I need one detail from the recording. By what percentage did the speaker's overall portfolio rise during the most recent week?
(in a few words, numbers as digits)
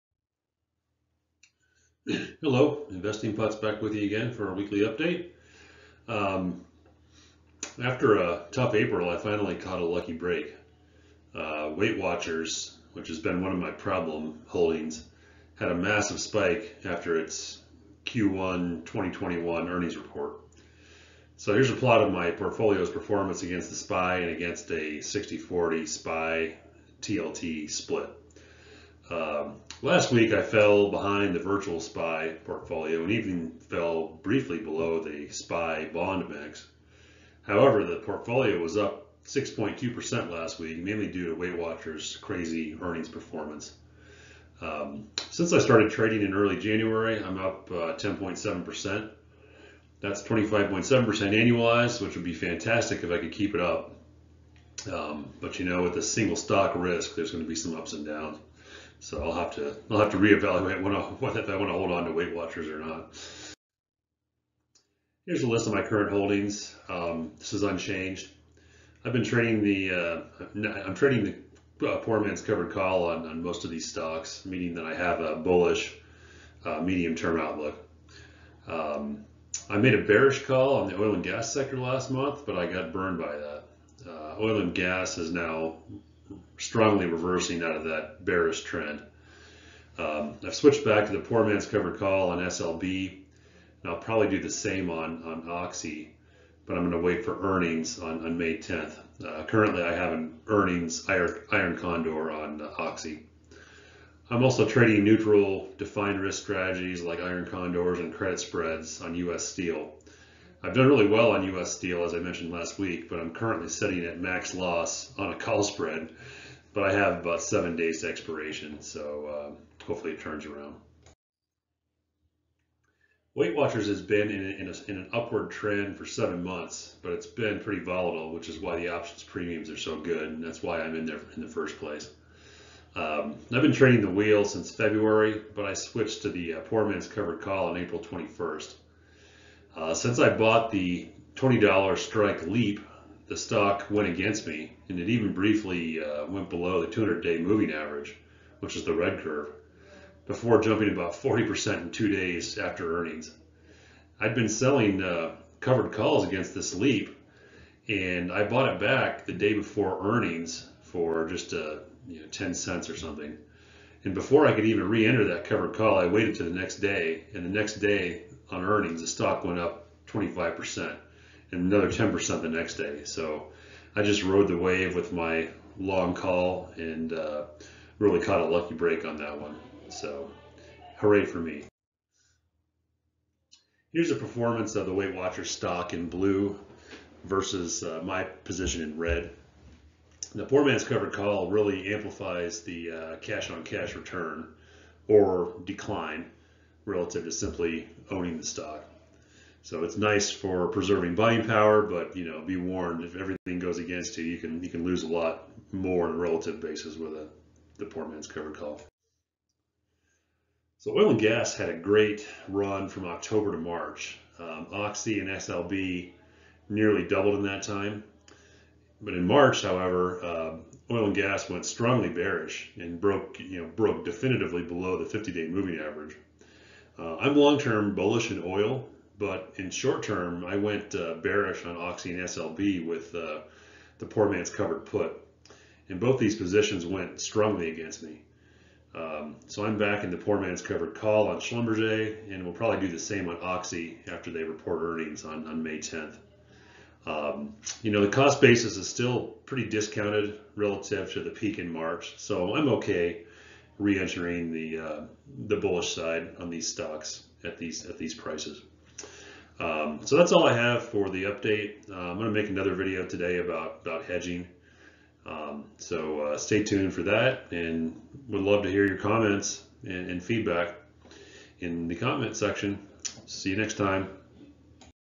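6.2%.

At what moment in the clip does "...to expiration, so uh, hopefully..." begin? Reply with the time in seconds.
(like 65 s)
118 s.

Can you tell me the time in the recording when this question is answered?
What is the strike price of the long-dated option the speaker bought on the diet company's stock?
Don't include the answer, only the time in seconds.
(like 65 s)
141 s.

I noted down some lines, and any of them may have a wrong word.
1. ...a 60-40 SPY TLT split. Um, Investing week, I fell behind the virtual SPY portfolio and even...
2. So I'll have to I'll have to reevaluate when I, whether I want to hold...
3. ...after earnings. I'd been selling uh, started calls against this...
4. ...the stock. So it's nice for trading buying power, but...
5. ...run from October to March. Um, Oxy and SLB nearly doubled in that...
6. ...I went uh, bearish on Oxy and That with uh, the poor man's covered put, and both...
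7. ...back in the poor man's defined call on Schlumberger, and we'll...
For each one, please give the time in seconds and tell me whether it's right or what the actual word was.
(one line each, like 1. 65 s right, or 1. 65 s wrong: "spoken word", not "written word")
1. 24 s wrong: "Last", not "Investing"
2. 59 s right
3. 152 s wrong: "covered", not "started"
4. 198 s wrong: "preserving", not "trading"
5. 212 s right
6. 230 s wrong: "SLB", not "That"
7. 239 s wrong: "covered", not "defined".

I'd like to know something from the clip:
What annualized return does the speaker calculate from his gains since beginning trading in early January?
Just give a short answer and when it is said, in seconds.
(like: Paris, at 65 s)
25.7%, at 50 s.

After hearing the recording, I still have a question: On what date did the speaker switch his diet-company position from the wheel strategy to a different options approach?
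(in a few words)
April 21st.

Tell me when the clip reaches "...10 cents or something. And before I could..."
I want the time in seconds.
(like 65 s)
162 s.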